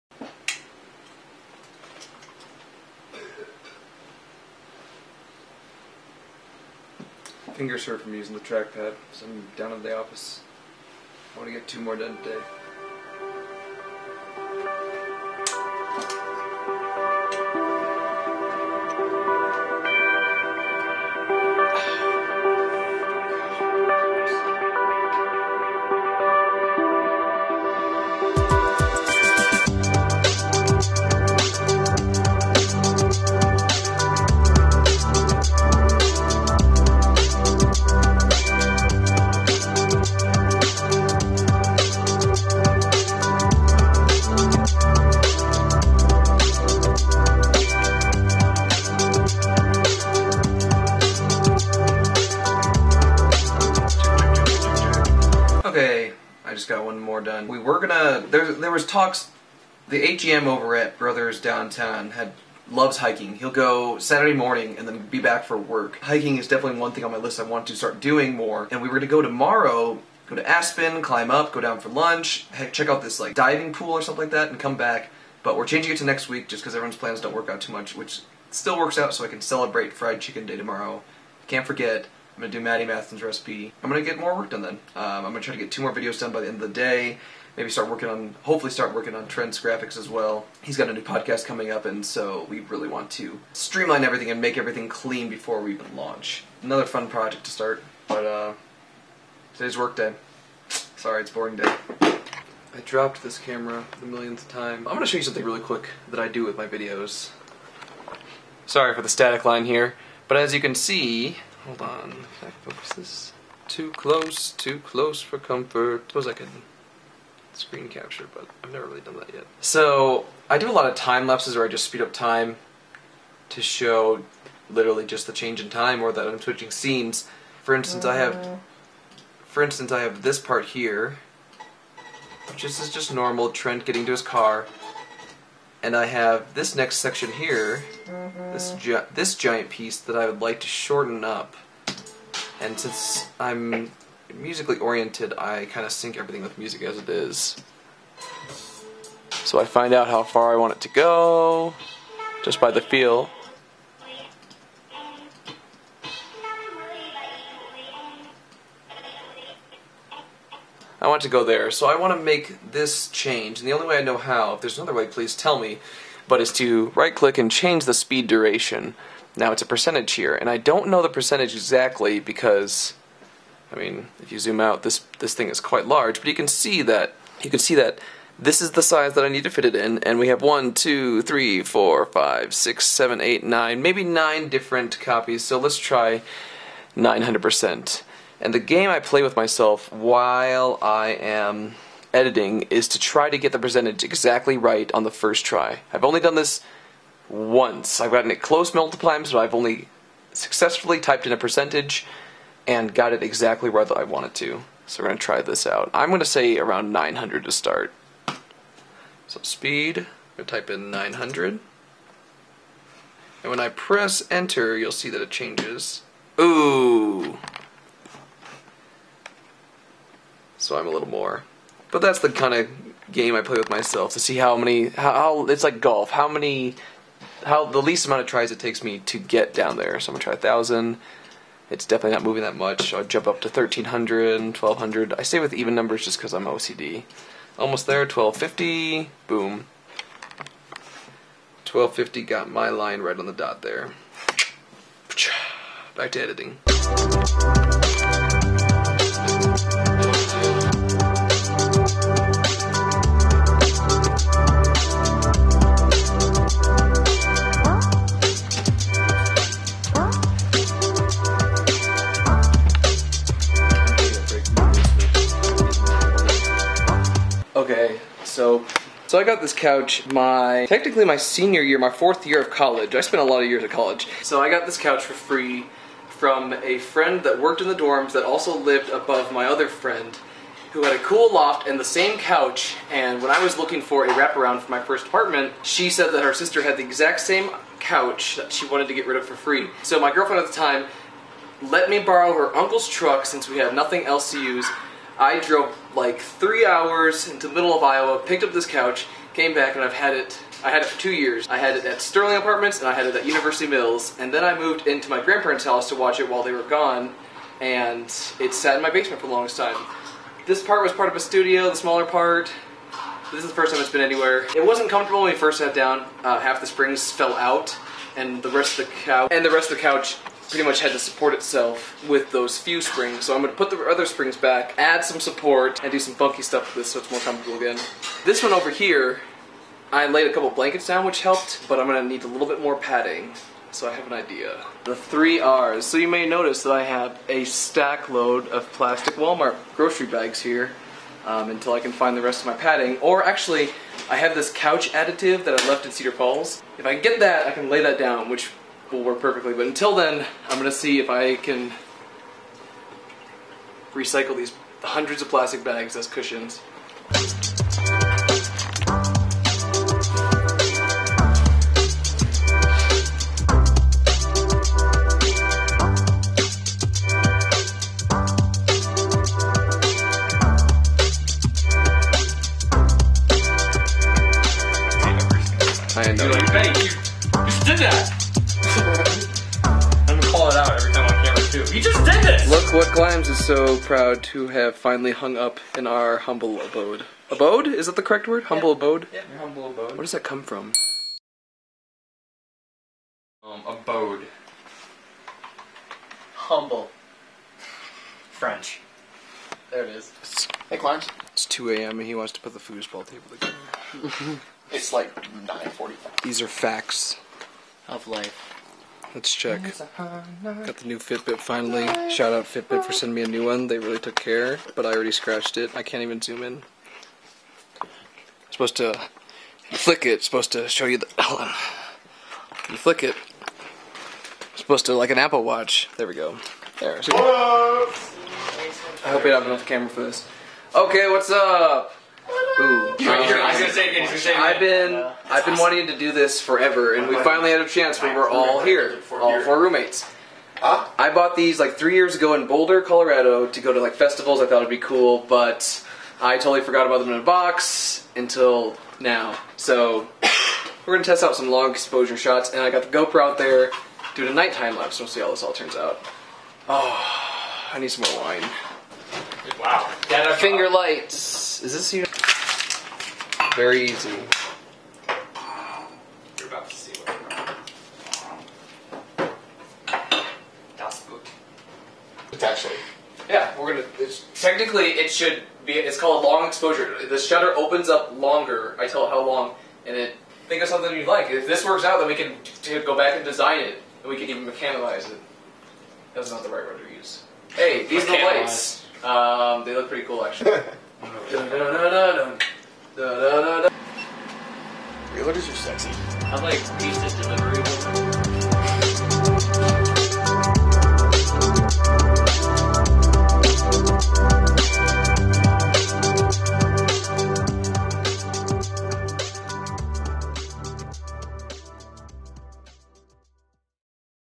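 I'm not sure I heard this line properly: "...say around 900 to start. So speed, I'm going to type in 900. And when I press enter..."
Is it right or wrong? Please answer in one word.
right.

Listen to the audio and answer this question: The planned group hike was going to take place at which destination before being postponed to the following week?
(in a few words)
Aspen.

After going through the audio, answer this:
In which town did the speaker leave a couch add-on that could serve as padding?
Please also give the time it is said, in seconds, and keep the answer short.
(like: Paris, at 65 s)
Cedar Falls, at 345 s.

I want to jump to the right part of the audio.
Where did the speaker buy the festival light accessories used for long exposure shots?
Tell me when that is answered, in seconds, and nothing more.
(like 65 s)
442 s.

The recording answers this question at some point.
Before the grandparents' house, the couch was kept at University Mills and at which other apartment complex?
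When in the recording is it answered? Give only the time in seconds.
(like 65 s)
302 s.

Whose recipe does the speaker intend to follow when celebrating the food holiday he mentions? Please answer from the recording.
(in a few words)
Matty Matheson.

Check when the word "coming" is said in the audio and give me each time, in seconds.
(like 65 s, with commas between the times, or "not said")
91 s.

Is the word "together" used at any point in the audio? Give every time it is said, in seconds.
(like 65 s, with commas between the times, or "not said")
403 s.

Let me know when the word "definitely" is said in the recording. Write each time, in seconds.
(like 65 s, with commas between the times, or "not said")
66 s, 231 s.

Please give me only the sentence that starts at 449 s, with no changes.
So we're gonna test out some long exposure shots, and I got the GoPro out there doing a nighttime lapse.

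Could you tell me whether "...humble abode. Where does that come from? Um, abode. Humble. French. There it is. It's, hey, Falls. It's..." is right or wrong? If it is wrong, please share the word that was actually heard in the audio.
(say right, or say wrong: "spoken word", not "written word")
wrong: "Climbs", not "Falls".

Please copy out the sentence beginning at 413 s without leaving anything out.
They really took care, but I already scratched it.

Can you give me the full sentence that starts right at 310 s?
This part was part of a studio, the smaller part.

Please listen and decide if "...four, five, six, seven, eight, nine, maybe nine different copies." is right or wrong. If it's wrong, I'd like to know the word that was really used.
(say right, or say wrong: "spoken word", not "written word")
right.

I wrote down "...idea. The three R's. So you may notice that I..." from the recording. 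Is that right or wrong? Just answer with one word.
right.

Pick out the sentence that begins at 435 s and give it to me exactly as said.
wanting to do this forever, and we finally had a chance.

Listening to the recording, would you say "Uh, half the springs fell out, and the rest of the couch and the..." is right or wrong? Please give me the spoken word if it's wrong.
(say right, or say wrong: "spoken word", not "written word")
right.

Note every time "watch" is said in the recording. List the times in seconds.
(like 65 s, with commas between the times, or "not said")
305 s, 425 s.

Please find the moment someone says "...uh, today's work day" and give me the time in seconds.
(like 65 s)
98 s.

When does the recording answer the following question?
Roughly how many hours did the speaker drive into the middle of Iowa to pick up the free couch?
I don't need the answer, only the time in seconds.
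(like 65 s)
296 s.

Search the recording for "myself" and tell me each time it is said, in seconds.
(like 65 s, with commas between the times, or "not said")
189 s, 223 s.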